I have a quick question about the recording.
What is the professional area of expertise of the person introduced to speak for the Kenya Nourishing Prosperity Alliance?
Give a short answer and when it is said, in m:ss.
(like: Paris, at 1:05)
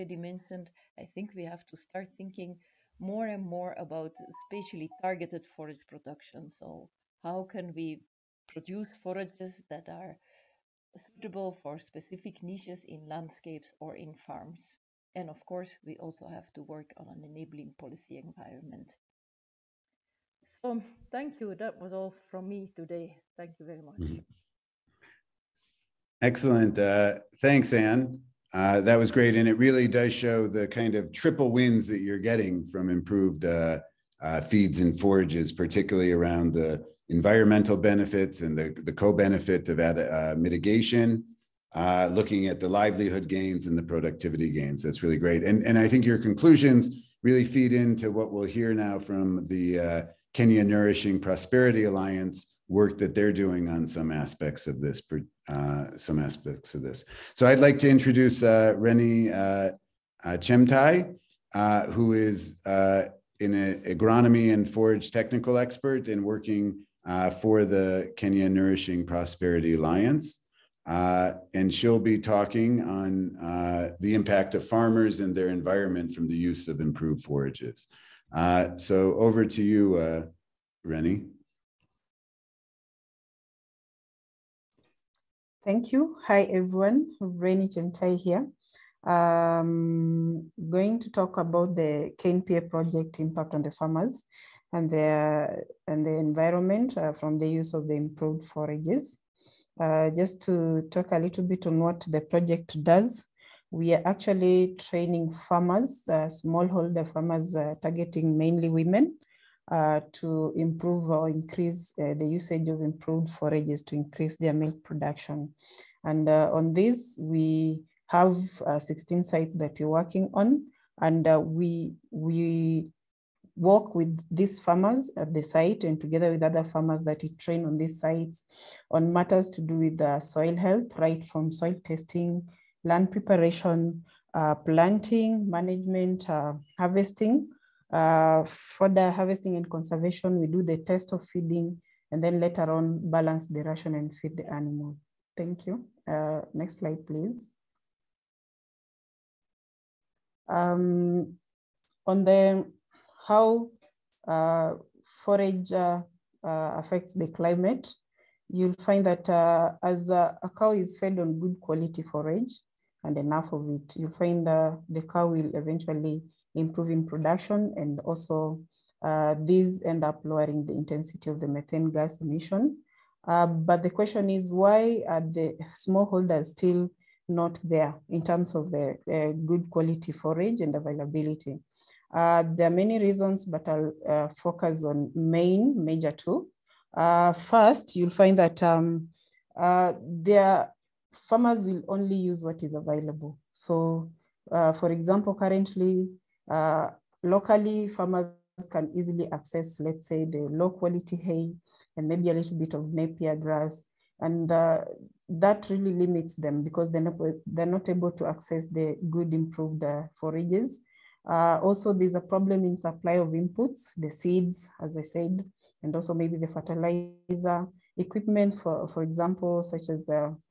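agronomy and forage, at 1:03.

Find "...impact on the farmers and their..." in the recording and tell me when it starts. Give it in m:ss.
1:33.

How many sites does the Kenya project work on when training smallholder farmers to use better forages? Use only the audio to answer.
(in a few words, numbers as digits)
16.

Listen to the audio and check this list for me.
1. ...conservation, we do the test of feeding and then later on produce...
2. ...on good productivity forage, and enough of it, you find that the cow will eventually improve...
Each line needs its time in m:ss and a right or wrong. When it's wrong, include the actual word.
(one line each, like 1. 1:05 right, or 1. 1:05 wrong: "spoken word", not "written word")
1. 2:19 wrong: "balance", not "produce"
2. 2:41 wrong: "quality", not "productivity".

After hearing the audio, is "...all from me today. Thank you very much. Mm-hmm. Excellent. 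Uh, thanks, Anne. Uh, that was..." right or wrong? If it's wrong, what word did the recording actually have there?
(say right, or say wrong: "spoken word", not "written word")
right.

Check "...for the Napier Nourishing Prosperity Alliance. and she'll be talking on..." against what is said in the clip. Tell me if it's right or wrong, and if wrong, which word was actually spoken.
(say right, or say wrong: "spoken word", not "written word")
wrong: "Kenya", not "Napier".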